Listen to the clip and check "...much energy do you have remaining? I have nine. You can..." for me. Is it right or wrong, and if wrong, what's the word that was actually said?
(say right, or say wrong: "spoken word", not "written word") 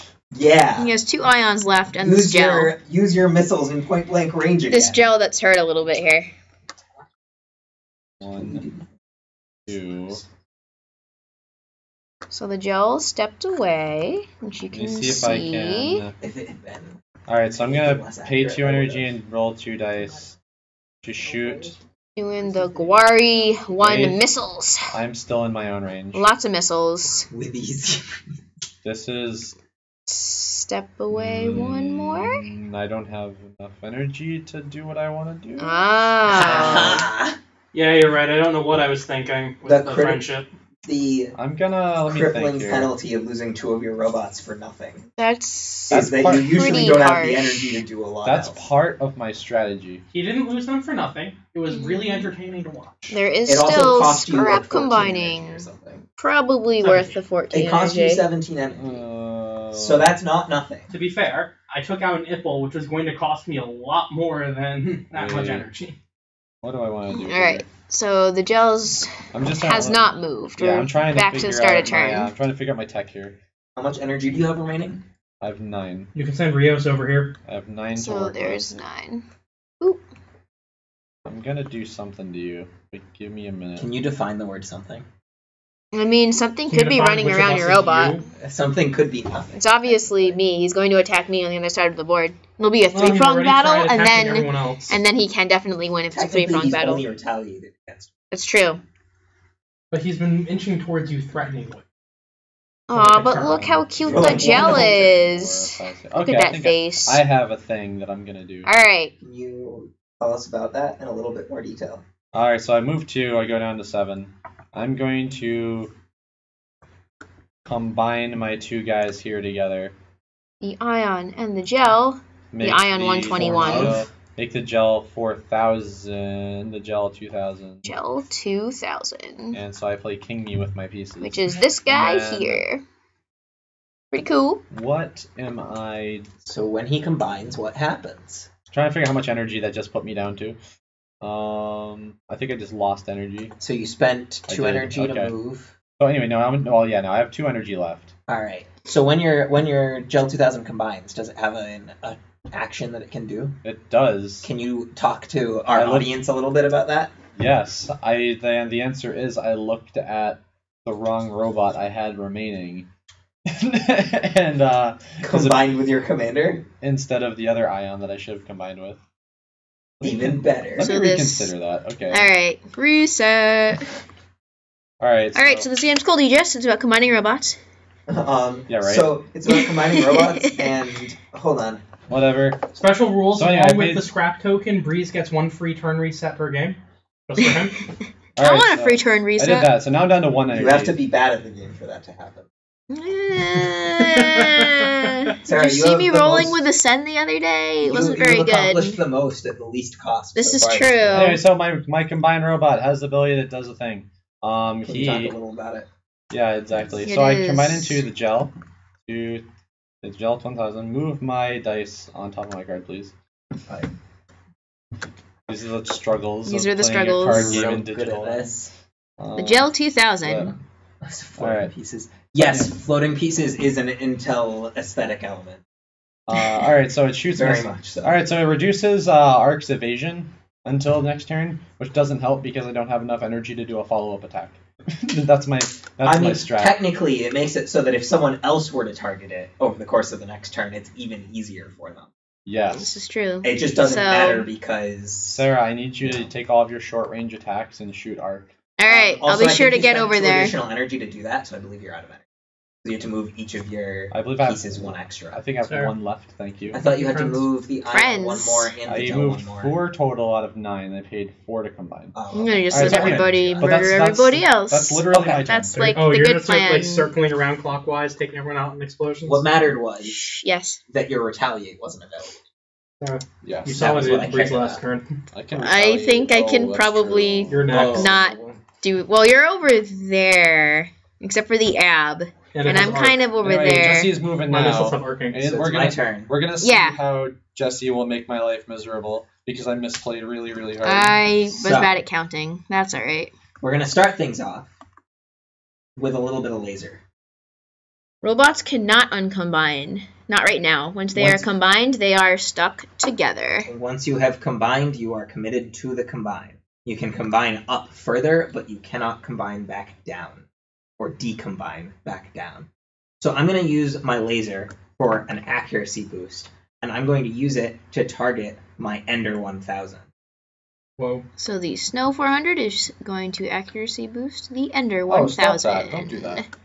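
right.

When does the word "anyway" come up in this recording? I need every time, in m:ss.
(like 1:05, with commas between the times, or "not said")
2:26, 3:03, 3:20, 4:43.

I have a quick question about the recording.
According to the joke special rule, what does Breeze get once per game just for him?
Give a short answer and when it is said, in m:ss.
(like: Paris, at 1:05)
One free turn reset, at 3:05.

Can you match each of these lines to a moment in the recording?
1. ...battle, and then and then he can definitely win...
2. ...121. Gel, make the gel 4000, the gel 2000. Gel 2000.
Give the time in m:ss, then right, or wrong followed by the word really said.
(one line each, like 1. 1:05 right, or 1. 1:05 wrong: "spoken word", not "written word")
1. 1:33 right
2. 2:03 right.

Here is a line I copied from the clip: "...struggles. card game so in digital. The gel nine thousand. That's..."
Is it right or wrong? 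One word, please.
wrong.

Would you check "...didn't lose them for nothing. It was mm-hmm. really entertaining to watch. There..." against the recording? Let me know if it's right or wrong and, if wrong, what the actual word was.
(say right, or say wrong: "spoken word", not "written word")
right.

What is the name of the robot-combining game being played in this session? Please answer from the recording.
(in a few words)
Aegis.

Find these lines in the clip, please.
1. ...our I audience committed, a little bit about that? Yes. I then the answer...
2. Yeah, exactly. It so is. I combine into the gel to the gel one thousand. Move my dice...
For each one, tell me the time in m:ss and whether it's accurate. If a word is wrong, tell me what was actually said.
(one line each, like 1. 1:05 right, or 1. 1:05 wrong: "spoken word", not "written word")
1. 2:35 wrong: "looked", not "committed"
2. 3:26 right.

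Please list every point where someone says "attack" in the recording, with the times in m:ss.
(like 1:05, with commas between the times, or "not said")
1:30, 3:54, 4:07.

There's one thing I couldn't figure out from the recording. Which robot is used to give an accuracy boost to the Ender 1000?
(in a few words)
Snow 400.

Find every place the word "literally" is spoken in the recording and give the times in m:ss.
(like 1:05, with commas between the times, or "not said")
4:24.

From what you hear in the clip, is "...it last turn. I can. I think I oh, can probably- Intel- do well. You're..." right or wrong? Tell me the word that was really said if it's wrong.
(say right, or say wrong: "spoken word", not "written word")
wrong: "Not", not "Intel".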